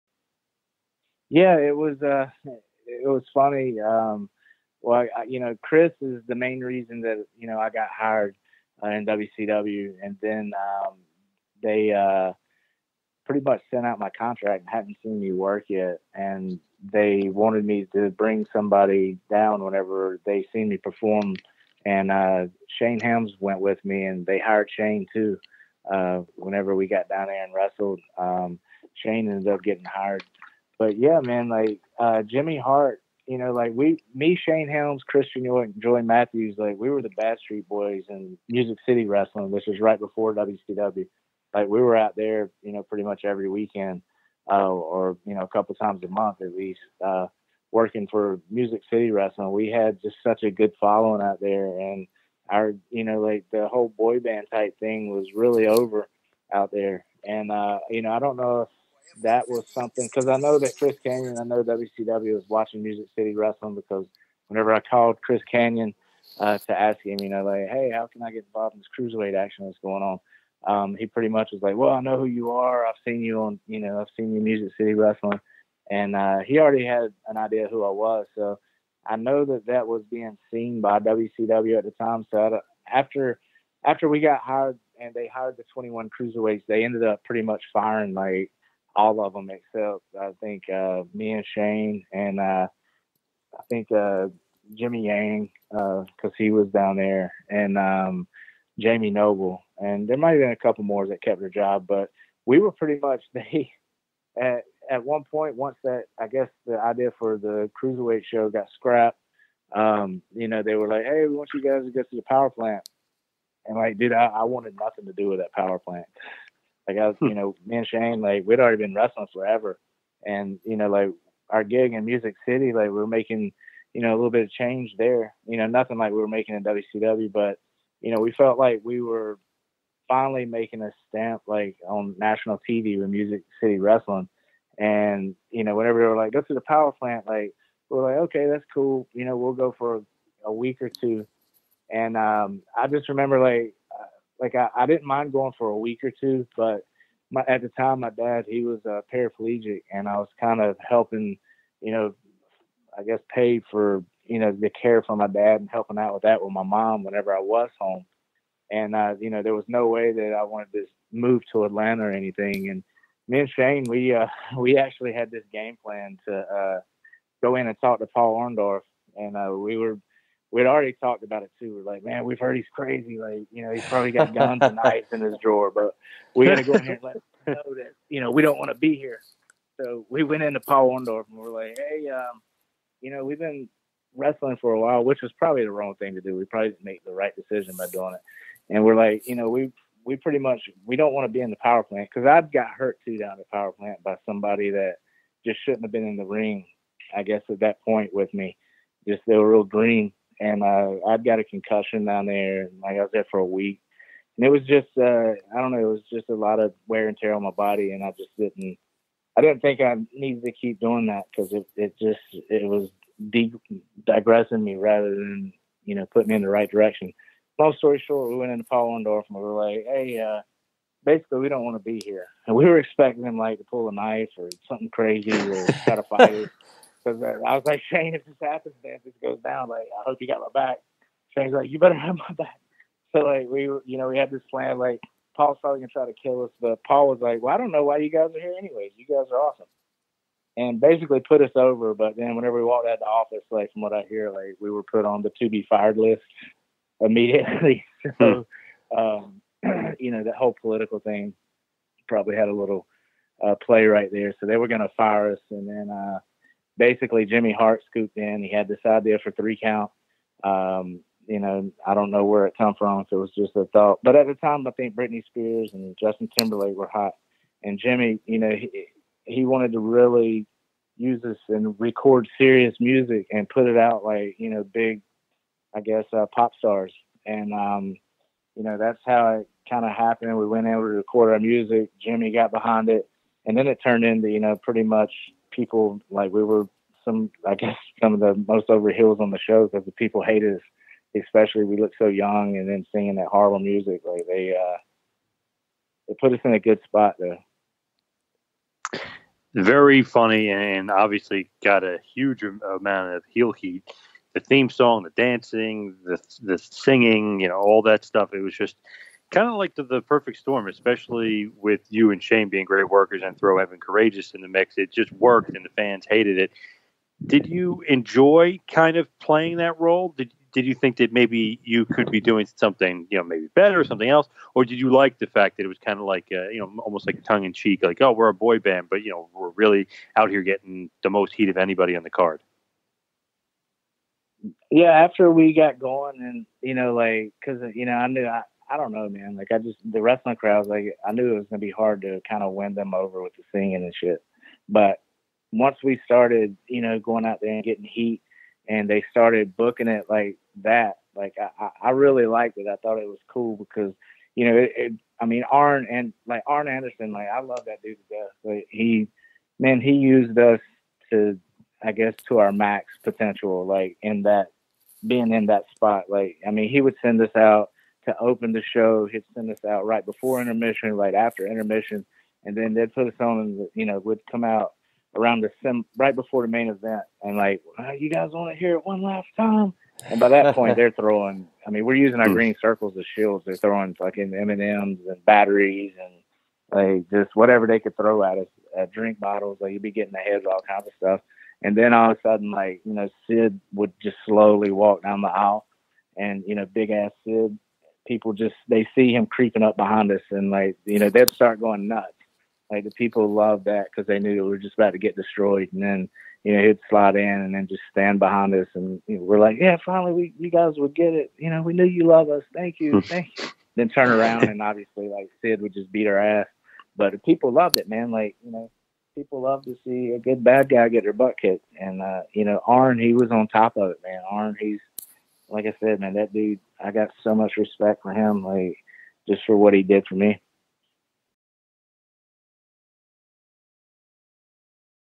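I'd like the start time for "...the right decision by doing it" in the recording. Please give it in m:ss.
3:07.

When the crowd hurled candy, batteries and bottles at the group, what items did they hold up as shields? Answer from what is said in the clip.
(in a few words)
Green circles.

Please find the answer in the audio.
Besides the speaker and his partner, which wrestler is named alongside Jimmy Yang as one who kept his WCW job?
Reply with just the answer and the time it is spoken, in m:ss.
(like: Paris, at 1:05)
Jamie Noble, at 1:38.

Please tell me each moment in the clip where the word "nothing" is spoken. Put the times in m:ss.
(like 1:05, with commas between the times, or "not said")
1:54, 2:05.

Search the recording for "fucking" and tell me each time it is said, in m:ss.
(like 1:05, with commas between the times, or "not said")
6:23.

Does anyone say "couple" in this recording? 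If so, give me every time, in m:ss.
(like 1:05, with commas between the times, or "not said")
0:45, 1:40.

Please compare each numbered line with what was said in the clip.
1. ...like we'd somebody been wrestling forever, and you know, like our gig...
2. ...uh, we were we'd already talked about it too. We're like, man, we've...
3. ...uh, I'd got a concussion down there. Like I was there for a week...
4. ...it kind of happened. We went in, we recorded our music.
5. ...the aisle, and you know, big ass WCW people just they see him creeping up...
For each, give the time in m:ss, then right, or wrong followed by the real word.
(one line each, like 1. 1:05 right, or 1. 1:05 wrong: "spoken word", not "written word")
1. 1:58 wrong: "already", not "somebody"
2. 2:49 right
3. 3:20 right
4. 4:39 right
5. 6:35 wrong: "Sid", not "WCW".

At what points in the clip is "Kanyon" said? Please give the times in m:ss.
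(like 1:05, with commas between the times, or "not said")
1:01, 1:05.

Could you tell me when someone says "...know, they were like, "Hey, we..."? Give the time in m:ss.
1:50.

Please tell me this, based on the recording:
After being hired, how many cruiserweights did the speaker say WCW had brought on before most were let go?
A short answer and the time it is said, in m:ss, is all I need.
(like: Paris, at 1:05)
21, at 1:25.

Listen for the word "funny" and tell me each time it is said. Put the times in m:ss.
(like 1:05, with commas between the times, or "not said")
0:03, 5:00.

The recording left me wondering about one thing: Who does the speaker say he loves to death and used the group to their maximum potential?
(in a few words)
Arn Anderson.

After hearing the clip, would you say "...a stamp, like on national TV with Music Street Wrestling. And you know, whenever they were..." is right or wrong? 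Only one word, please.
wrong.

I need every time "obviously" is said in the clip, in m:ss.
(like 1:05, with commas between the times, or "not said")
5:00, 6:54.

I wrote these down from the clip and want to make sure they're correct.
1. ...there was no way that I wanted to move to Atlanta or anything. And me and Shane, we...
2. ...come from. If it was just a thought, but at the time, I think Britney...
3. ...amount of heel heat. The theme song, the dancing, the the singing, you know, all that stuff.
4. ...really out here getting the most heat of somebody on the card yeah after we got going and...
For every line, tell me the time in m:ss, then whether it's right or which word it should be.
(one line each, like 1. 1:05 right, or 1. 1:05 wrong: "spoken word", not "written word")
1. 2:39 right
2. 4:22 right
3. 5:02 right
4. 5:29 wrong: "anybody", not "somebody".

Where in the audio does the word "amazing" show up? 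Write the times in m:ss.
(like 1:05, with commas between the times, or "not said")
not said.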